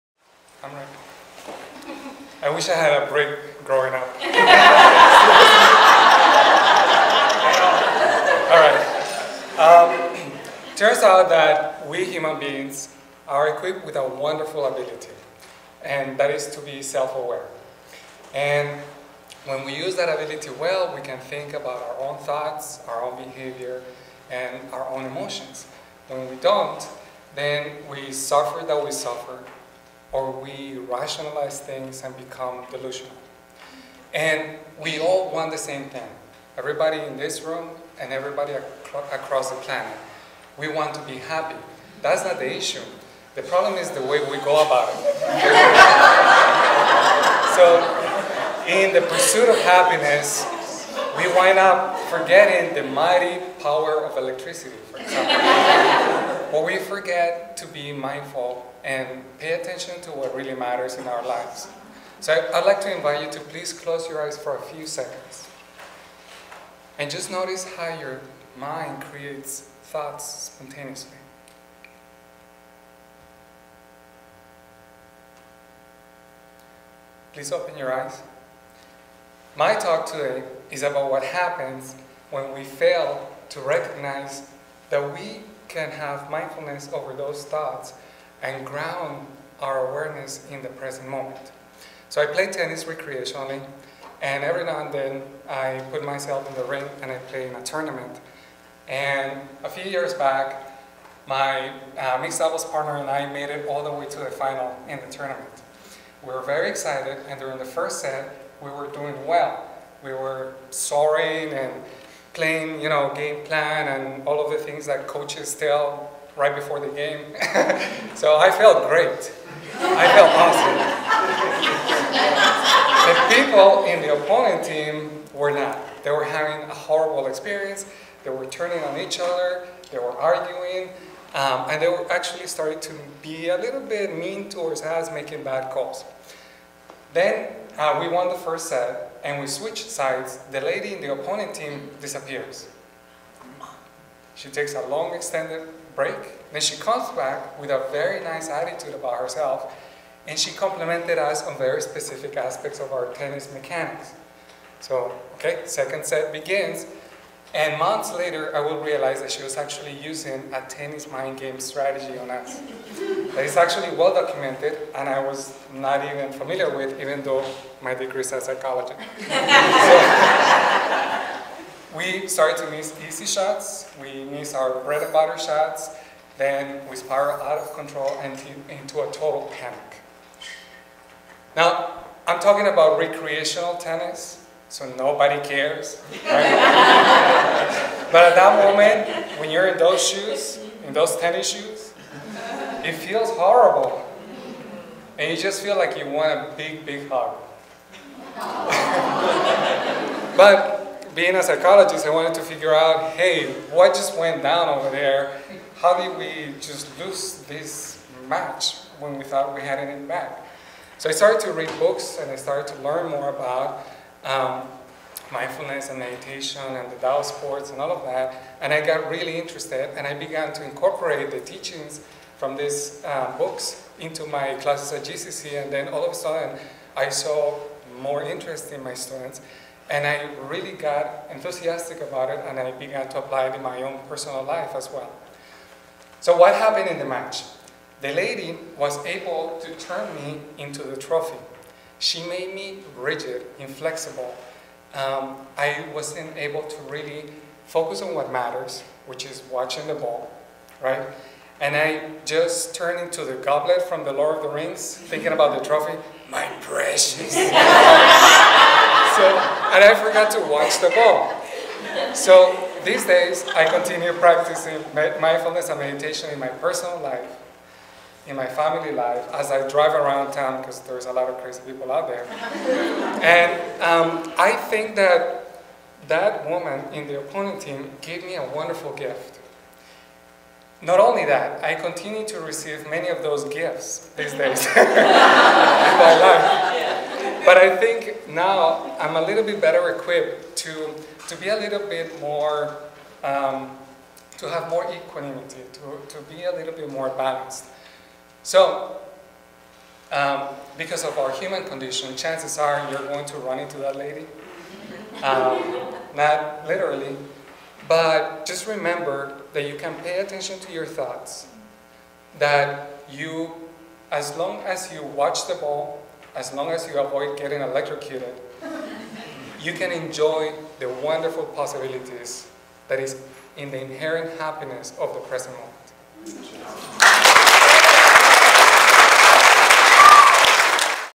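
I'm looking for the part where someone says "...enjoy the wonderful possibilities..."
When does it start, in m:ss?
5:19.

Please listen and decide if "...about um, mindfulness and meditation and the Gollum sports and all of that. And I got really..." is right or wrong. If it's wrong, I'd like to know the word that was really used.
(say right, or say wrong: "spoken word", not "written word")
wrong: "Tao", not "Gollum".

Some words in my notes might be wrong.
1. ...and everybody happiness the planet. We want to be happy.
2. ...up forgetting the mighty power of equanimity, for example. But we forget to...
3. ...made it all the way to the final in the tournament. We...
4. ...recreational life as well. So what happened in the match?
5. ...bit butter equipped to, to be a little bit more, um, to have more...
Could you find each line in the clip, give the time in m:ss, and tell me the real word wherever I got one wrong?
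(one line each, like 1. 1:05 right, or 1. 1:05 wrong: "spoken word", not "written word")
1. 0:37 wrong: "across", not "happiness"
2. 0:51 wrong: "electricity", not "equanimity"
3. 1:43 right
4. 3:54 wrong: "personal", not "recreational"
5. 4:49 wrong: "better", not "butter".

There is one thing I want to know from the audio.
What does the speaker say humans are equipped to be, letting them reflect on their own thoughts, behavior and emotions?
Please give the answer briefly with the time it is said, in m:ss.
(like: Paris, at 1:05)
Self-aware, at 0:16.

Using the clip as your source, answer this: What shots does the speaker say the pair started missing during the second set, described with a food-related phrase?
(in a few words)
Bread and butter shots.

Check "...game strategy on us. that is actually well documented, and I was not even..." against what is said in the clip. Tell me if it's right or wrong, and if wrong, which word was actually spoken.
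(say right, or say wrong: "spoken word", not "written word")
right.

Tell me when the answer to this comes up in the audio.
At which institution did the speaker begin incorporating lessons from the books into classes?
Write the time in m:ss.
3:45.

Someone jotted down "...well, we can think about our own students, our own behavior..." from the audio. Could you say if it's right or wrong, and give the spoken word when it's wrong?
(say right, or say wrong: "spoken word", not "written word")
wrong: "thoughts", not "students".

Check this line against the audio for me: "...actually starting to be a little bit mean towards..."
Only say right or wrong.
right.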